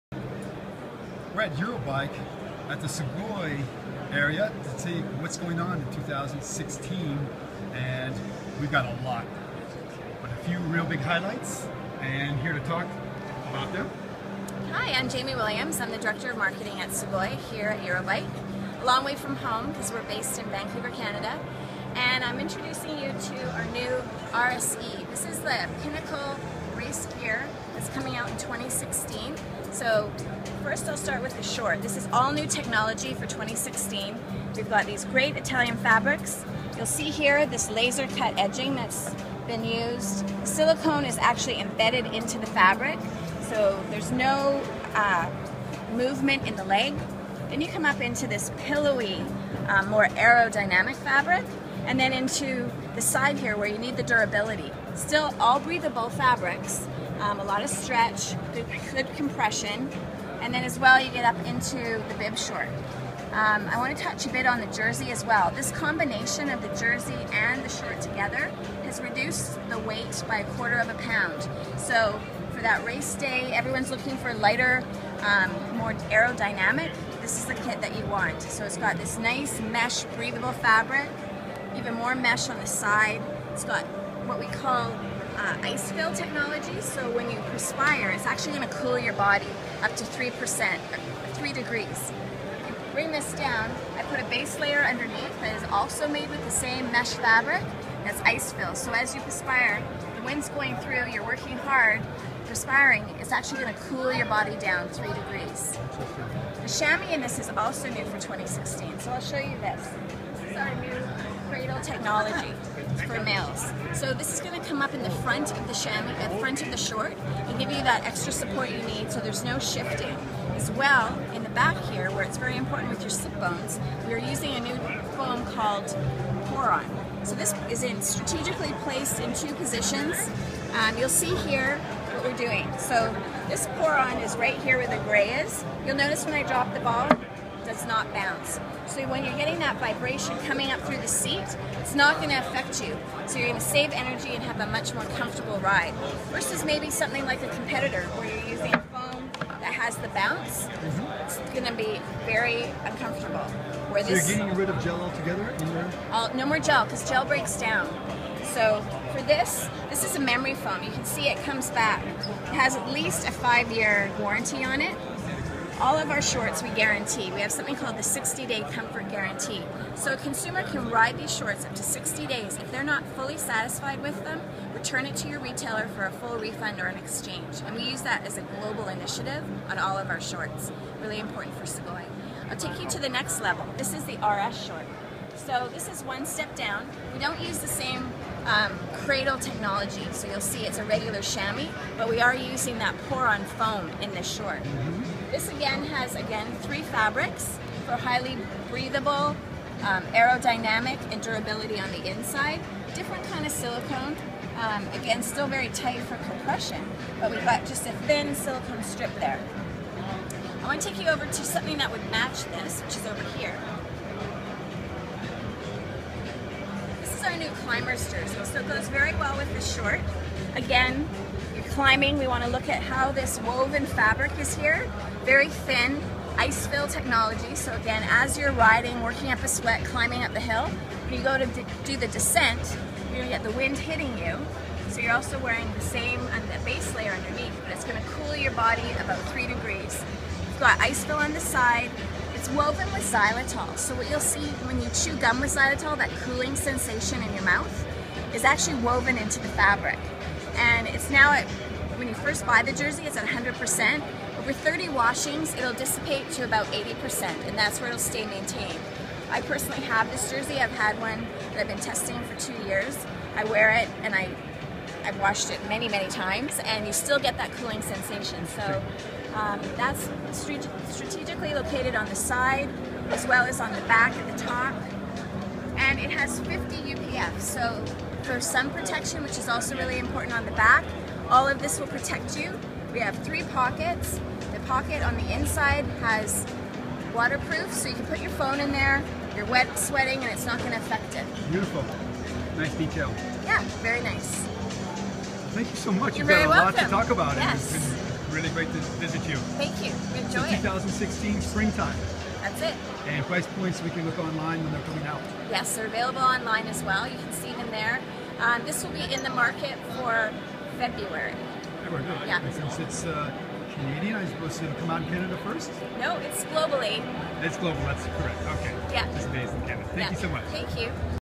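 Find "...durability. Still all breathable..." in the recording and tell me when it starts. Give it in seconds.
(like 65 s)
54 s.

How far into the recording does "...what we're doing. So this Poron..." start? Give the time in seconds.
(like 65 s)
132 s.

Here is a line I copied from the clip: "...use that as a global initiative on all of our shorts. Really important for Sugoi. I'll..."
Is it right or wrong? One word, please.
right.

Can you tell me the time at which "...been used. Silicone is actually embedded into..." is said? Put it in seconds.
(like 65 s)
39 s.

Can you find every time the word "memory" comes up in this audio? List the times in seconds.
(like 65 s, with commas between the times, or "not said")
160 s.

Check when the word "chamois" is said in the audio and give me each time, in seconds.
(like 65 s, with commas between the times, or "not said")
106 s, 115 s, 191 s.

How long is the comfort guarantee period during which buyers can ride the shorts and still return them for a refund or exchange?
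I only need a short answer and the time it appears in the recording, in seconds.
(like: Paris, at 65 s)
60 days, at 171 s.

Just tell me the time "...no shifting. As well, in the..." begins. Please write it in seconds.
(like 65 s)
119 s.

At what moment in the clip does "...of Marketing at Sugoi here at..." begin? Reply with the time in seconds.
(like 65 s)
16 s.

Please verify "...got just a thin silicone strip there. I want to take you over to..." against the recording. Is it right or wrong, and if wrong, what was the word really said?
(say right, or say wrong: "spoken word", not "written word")
right.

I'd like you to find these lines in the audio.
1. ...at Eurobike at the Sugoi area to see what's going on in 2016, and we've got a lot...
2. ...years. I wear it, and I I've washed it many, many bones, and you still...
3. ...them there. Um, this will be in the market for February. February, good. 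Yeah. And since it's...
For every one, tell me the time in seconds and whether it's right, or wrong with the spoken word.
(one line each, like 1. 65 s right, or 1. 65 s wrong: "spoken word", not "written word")
1. 1 s right
2. 262 s wrong: "times", not "bones"
3. 307 s right.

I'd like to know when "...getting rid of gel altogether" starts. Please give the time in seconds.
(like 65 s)
154 s.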